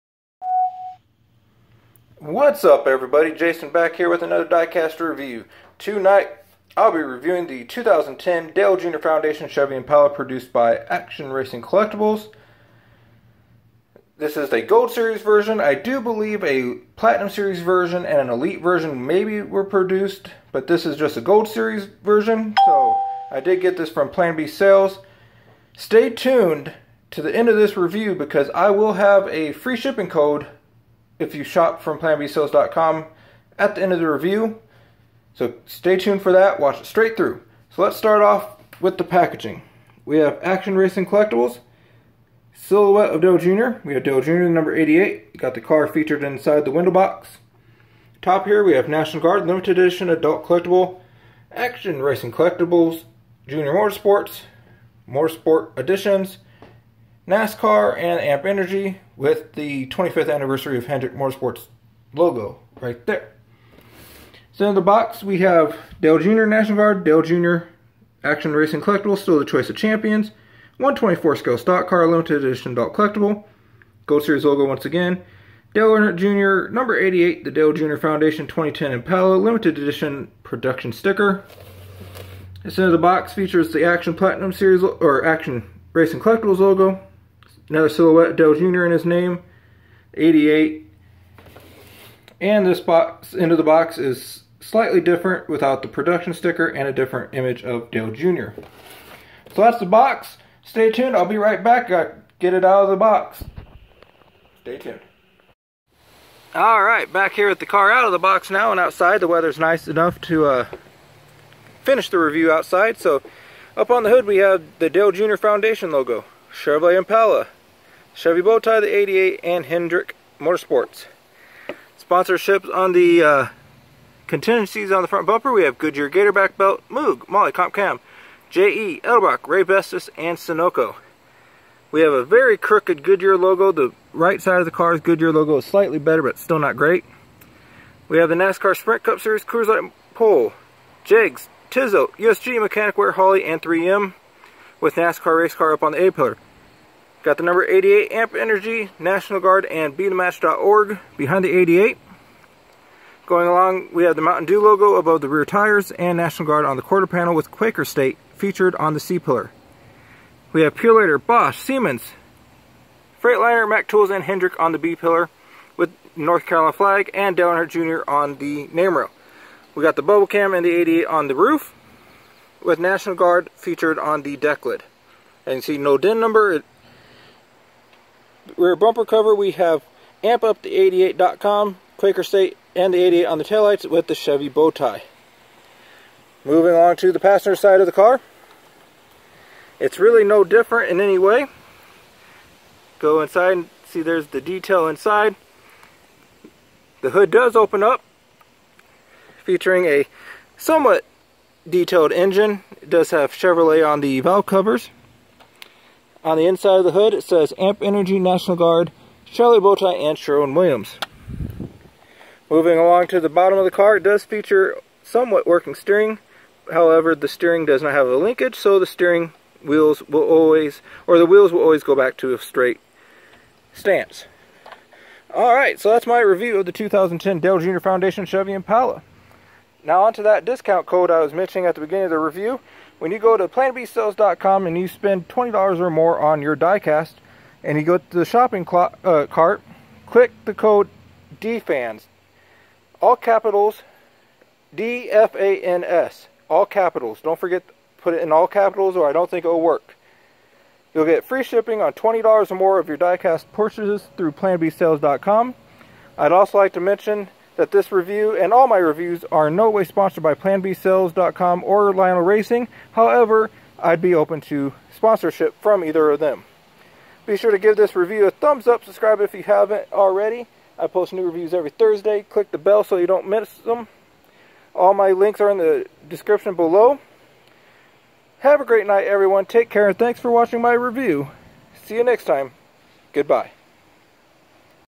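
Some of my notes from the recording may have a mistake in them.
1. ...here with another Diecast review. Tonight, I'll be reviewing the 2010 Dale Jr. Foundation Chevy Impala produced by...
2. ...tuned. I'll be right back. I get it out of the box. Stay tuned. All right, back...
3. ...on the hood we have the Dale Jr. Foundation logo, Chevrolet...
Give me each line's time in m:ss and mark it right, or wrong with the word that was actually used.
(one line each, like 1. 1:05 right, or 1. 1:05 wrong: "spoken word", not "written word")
1. 0:03 right
2. 1:40 right
3. 1:53 right.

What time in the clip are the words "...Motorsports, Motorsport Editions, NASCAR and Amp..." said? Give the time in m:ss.
0:53.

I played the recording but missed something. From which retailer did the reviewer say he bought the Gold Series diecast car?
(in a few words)
Plan B Sales.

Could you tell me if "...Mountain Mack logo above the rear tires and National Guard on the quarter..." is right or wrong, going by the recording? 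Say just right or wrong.
wrong.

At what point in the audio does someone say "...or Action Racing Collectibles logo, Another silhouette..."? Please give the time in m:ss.
1:24.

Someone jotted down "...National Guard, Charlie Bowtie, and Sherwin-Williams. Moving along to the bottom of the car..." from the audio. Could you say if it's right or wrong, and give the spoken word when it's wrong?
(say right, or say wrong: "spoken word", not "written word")
right.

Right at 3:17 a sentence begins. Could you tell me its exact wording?
The hood does open up, featuring a somewhat detailed engine.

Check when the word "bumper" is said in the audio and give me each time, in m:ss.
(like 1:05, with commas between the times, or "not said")
2:05, 2:58.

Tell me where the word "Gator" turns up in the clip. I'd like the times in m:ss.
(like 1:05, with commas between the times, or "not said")
2:06.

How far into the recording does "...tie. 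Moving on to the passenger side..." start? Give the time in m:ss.
3:04.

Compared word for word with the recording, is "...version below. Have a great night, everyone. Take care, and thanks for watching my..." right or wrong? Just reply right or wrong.
wrong.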